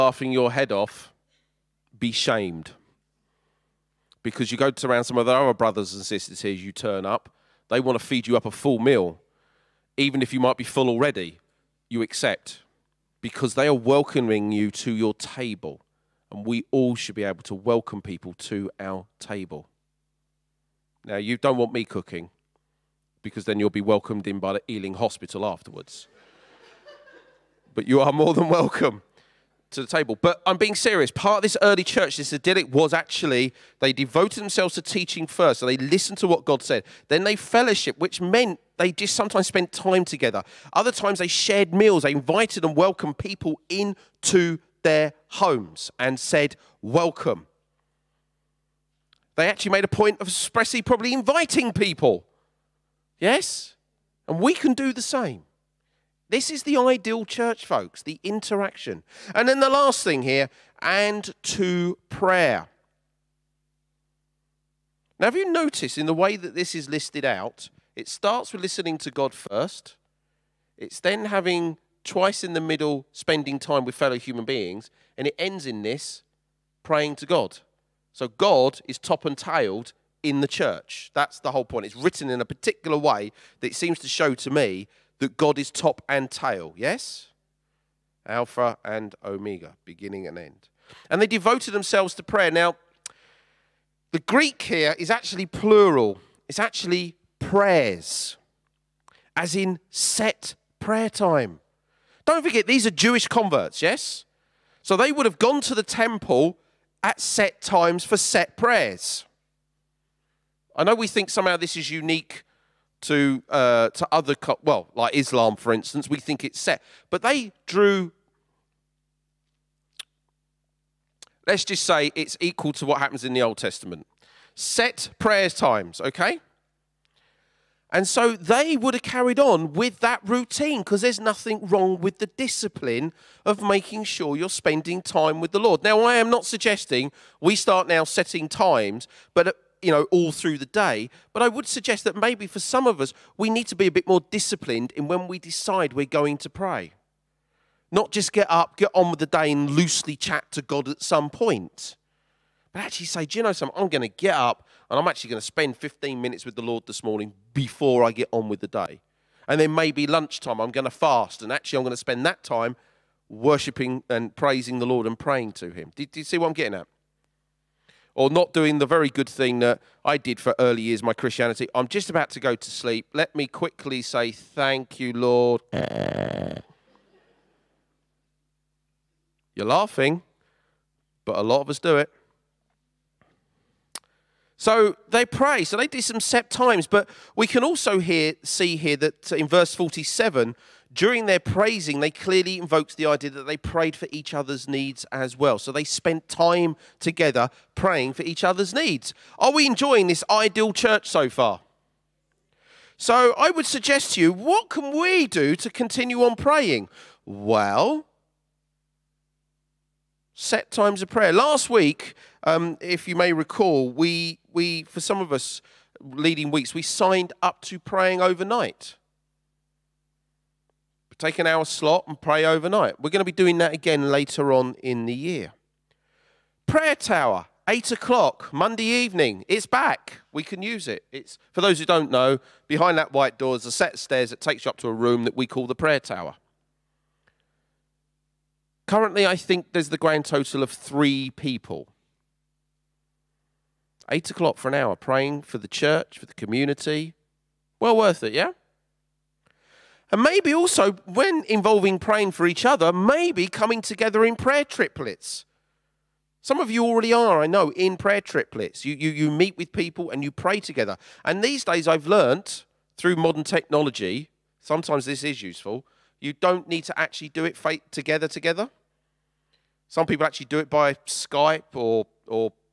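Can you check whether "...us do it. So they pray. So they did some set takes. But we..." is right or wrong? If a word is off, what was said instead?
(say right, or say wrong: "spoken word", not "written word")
wrong: "times", not "takes".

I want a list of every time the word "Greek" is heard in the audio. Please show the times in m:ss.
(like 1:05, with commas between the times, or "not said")
1:34.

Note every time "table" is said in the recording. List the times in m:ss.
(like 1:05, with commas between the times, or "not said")
0:15, 0:19, 0:29.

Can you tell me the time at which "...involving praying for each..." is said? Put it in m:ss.
4:11.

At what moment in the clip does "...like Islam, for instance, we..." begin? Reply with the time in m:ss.
1:54.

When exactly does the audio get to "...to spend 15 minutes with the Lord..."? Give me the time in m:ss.
2:35.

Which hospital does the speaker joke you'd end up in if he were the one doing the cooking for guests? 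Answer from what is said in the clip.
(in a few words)
Ealing Hospital.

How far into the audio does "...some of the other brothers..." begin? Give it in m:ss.
0:05.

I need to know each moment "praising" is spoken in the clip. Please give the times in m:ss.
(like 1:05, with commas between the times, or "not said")
2:44, 3:11.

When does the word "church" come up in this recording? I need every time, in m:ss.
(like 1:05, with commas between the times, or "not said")
0:31, 0:57, 1:20, 3:20, 4:05.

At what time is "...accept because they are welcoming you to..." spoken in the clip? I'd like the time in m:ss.
0:12.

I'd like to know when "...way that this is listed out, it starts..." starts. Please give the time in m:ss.
1:06.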